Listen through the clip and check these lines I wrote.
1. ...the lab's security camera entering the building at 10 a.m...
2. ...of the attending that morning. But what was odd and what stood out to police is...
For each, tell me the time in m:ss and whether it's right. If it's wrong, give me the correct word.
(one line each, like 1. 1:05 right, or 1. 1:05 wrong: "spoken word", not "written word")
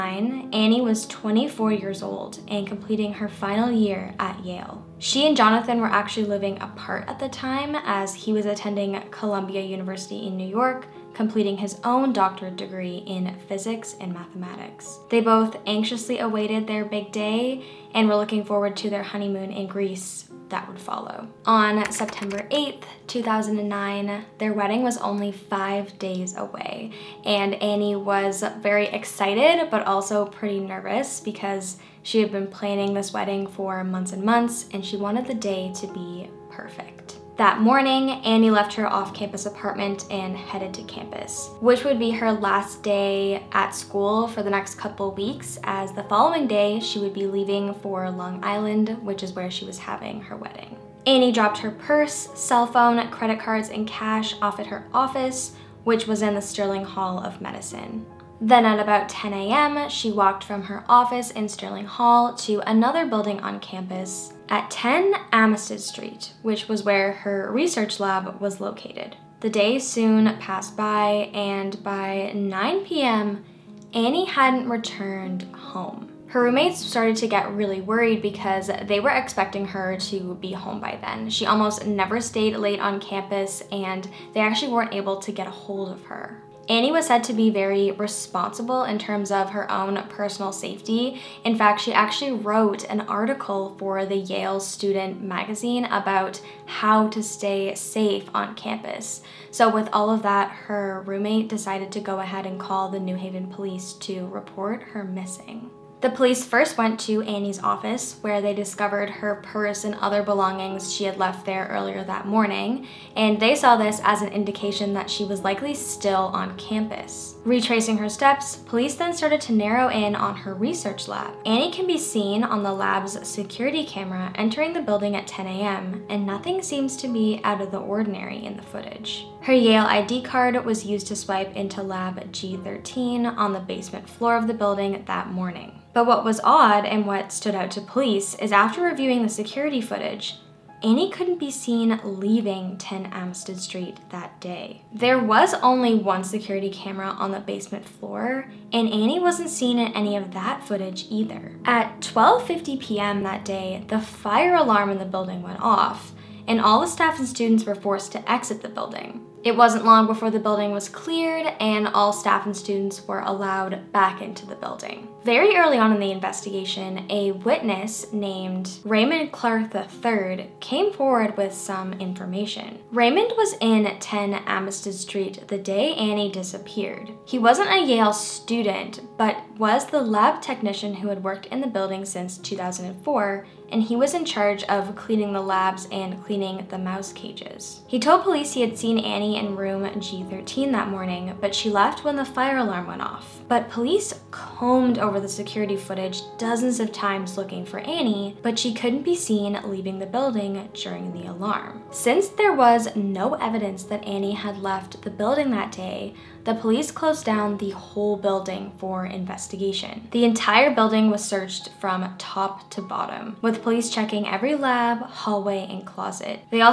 1. 2:02 right
2. 2:14 wrong: "building", not "attending".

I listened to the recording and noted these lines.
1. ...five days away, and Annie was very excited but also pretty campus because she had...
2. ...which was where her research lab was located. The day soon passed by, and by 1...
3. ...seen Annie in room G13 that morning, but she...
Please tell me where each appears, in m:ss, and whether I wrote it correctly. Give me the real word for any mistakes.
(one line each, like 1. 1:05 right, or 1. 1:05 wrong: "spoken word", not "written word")
1. 0:25 wrong: "nervous", not "campus"
2. 1:06 wrong: "9", not "1"
3. 3:08 right.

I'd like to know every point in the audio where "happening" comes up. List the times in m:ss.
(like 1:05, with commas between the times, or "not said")
not said.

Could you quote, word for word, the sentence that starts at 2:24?
There was only one security camera on the basement floor, and Annie wasn't seen in any of that footage either.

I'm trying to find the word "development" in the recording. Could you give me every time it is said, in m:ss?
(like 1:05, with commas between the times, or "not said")
not said.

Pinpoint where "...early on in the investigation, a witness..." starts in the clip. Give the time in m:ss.
2:45.